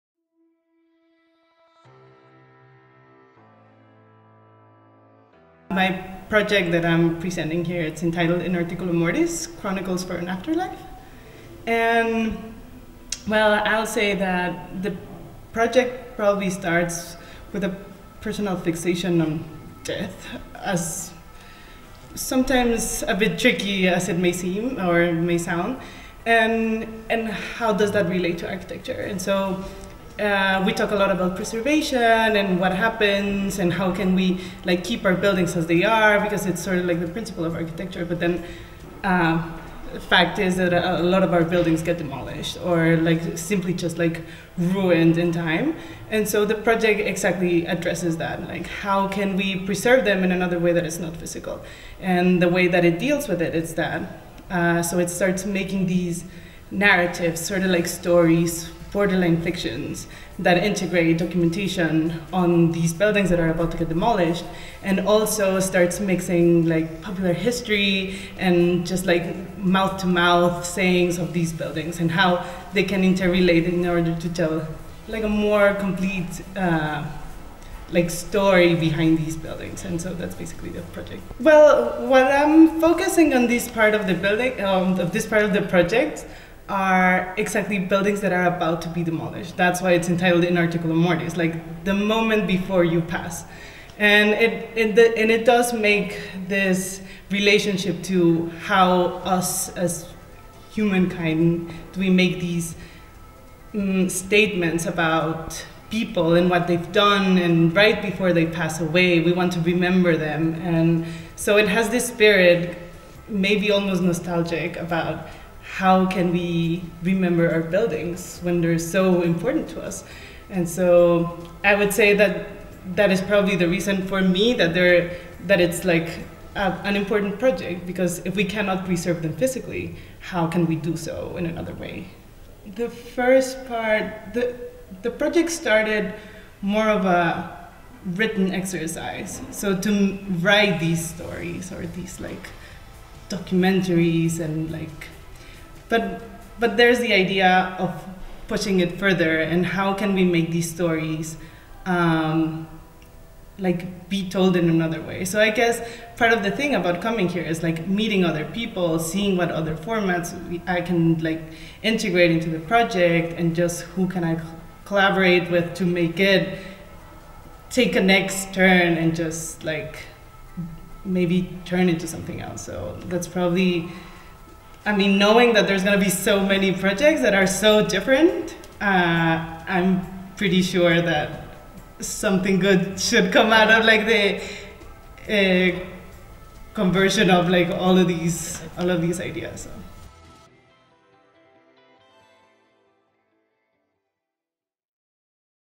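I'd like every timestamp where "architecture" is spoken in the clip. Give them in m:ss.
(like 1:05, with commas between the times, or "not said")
0:28, 0:37.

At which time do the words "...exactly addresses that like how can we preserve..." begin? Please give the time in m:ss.
0:46.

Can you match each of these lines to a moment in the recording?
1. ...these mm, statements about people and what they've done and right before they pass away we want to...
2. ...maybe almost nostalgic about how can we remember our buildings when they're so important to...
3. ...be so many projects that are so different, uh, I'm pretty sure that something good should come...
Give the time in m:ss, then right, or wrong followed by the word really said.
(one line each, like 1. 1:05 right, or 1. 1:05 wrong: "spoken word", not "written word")
1. 1:42 right
2. 1:53 right
3. 2:56 right.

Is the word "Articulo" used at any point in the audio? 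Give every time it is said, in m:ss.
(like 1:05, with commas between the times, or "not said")
0:08, 1:30.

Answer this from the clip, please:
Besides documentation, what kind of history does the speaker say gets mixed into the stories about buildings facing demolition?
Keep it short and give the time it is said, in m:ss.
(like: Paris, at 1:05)
popular history, at 1:07.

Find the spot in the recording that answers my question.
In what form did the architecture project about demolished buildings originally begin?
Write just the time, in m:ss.
2:17.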